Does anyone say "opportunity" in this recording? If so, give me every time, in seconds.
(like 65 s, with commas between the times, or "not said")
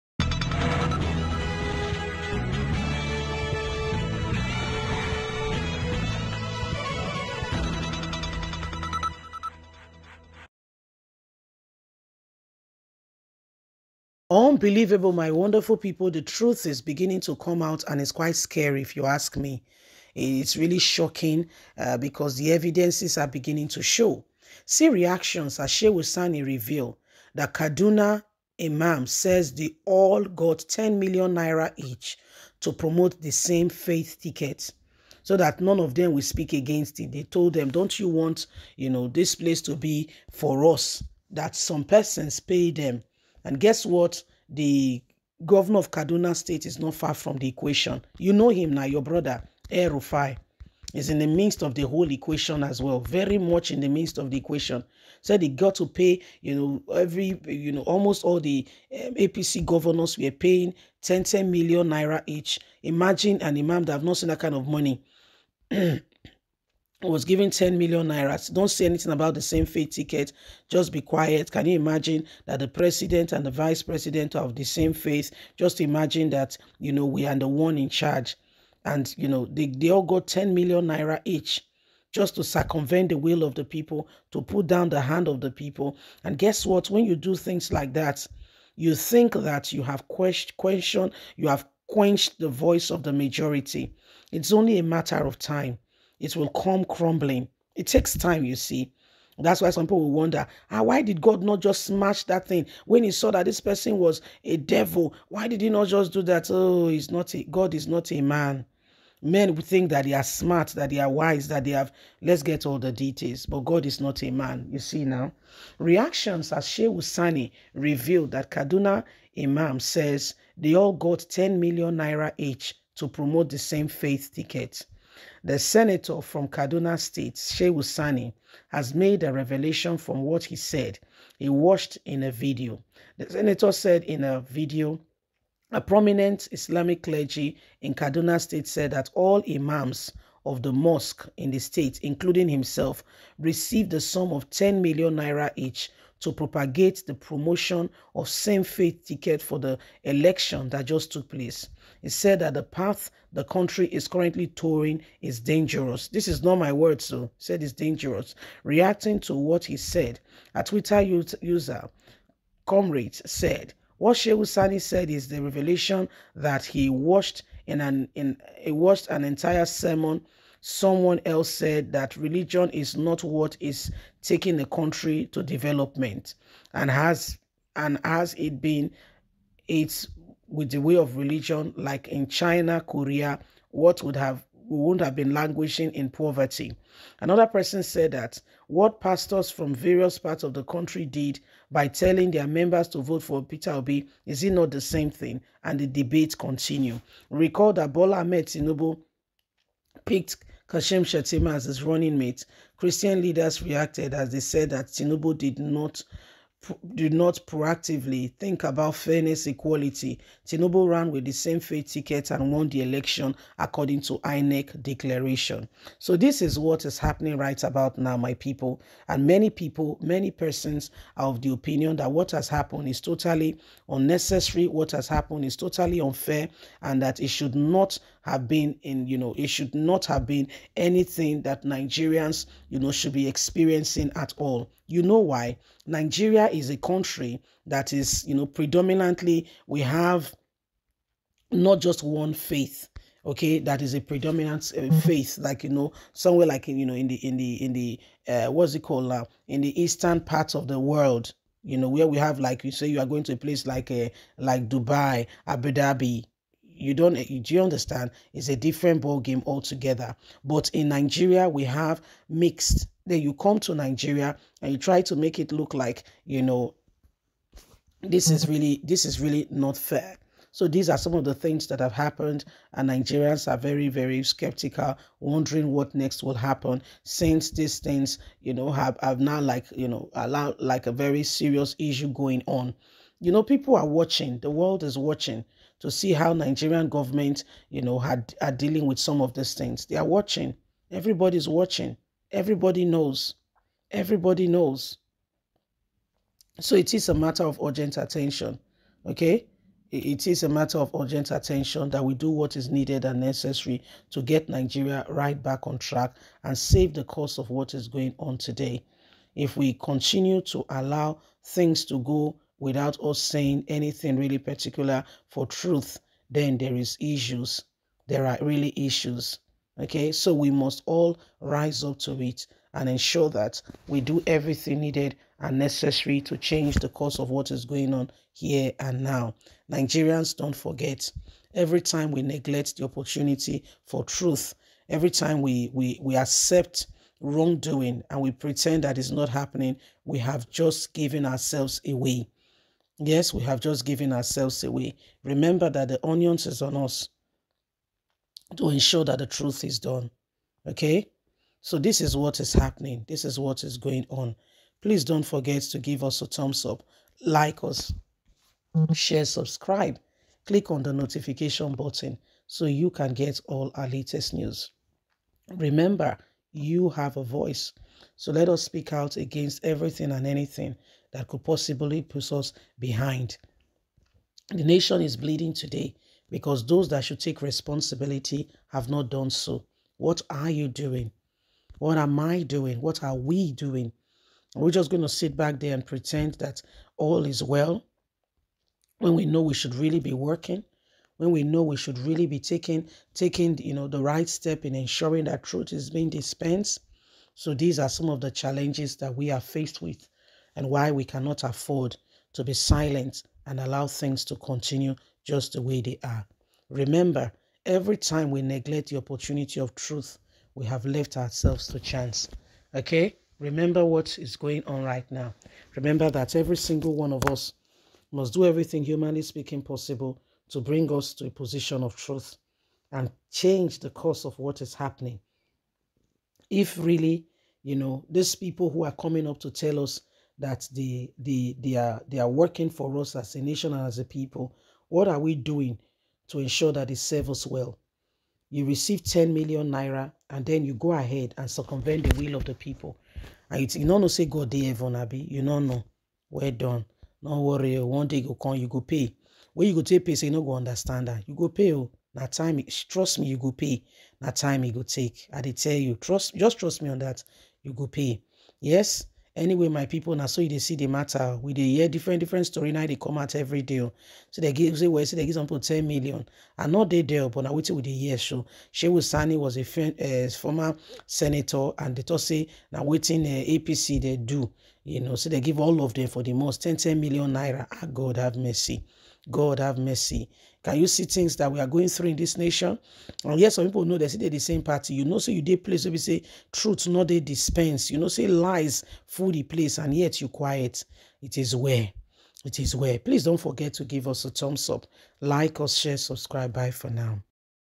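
332 s, 408 s.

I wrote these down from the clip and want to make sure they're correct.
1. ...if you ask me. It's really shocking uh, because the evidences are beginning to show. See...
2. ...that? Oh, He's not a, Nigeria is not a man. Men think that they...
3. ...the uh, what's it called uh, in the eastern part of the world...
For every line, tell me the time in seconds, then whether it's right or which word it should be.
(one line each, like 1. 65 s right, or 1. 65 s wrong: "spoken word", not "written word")
1. 18 s right
2. 106 s wrong: "God", not "Nigeria"
3. 247 s right.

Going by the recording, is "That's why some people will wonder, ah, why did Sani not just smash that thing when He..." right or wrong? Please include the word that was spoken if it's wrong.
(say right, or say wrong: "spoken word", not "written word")
wrong: "God", not "Sani".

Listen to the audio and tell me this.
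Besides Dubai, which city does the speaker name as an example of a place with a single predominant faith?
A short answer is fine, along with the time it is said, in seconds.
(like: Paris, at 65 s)
Abu Dhabi, at 255 s.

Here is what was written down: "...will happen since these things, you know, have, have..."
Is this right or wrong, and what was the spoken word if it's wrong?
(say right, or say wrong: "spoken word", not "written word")
right.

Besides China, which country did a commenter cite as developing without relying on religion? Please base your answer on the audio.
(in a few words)
Korea.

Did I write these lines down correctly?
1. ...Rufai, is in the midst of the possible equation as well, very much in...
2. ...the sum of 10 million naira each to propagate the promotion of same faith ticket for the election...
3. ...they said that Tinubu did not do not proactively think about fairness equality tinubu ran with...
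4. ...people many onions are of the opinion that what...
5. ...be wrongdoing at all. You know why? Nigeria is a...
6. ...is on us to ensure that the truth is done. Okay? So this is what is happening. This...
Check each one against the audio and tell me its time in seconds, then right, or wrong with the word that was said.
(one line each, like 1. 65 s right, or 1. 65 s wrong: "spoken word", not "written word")
1. 49 s wrong: "whole", not "possible"
2. 143 s right
3. 204 s right
4. 219 s wrong: "persons", not "onions"
5. 233 s wrong: "experiencing", not "wrongdoing"
6. 346 s right.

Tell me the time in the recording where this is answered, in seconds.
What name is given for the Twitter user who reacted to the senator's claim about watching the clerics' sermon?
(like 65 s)
162 s.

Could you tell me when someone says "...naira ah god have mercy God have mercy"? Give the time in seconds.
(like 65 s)
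477 s.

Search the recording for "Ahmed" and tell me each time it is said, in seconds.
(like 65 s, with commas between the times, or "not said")
198 s.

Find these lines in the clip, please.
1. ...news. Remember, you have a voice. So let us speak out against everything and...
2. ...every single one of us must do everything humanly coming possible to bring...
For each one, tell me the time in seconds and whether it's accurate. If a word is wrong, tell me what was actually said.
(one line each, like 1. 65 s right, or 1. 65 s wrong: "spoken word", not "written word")
1. 364 s right
2. 416 s wrong: "speaking", not "coming".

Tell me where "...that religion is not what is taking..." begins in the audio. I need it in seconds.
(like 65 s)
171 s.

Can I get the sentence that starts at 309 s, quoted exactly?
If we continue to allow things to go without us saying anything really particular for truth, then there is issues.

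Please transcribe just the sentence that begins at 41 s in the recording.
That some persons pay them and guess what?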